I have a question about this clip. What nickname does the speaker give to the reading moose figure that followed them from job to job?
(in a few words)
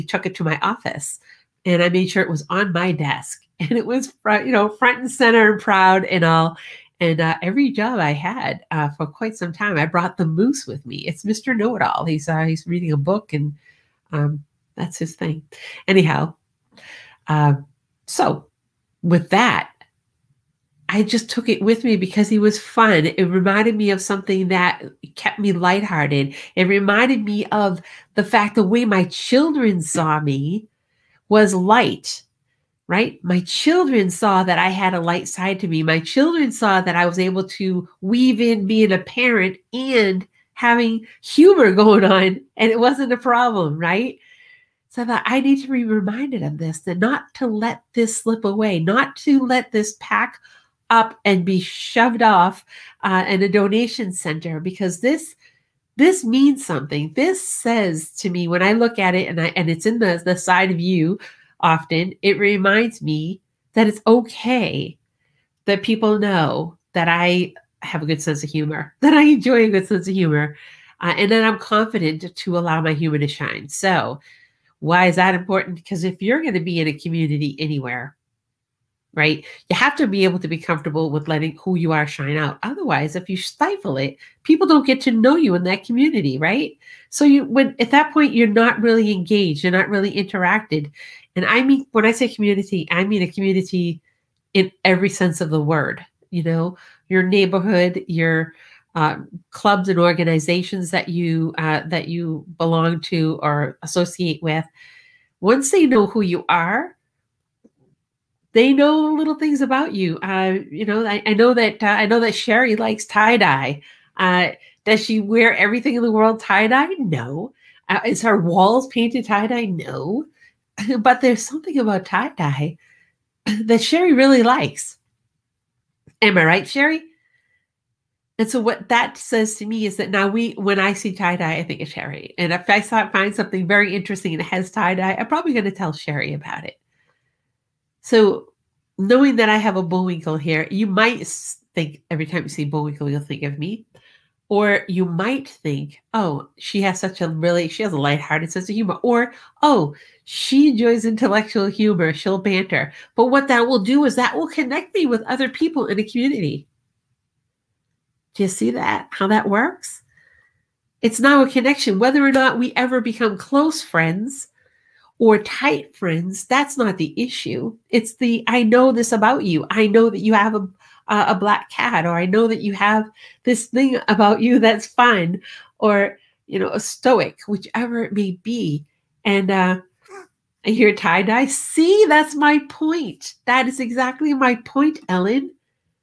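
Mister Know It All.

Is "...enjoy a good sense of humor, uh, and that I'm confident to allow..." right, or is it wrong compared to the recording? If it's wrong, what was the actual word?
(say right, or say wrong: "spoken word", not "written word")
right.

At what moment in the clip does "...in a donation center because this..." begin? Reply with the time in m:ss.
0:53.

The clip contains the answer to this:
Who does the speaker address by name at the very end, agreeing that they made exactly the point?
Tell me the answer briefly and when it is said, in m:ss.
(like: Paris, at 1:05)
Ellen, at 3:05.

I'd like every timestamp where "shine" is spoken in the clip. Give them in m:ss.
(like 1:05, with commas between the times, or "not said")
1:13, 1:22.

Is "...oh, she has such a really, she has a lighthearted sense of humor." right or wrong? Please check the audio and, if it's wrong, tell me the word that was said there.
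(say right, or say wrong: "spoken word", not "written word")
right.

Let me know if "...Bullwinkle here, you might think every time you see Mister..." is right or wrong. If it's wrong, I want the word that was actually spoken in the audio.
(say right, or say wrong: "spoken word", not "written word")
wrong: "Bullwinkle", not "Mister".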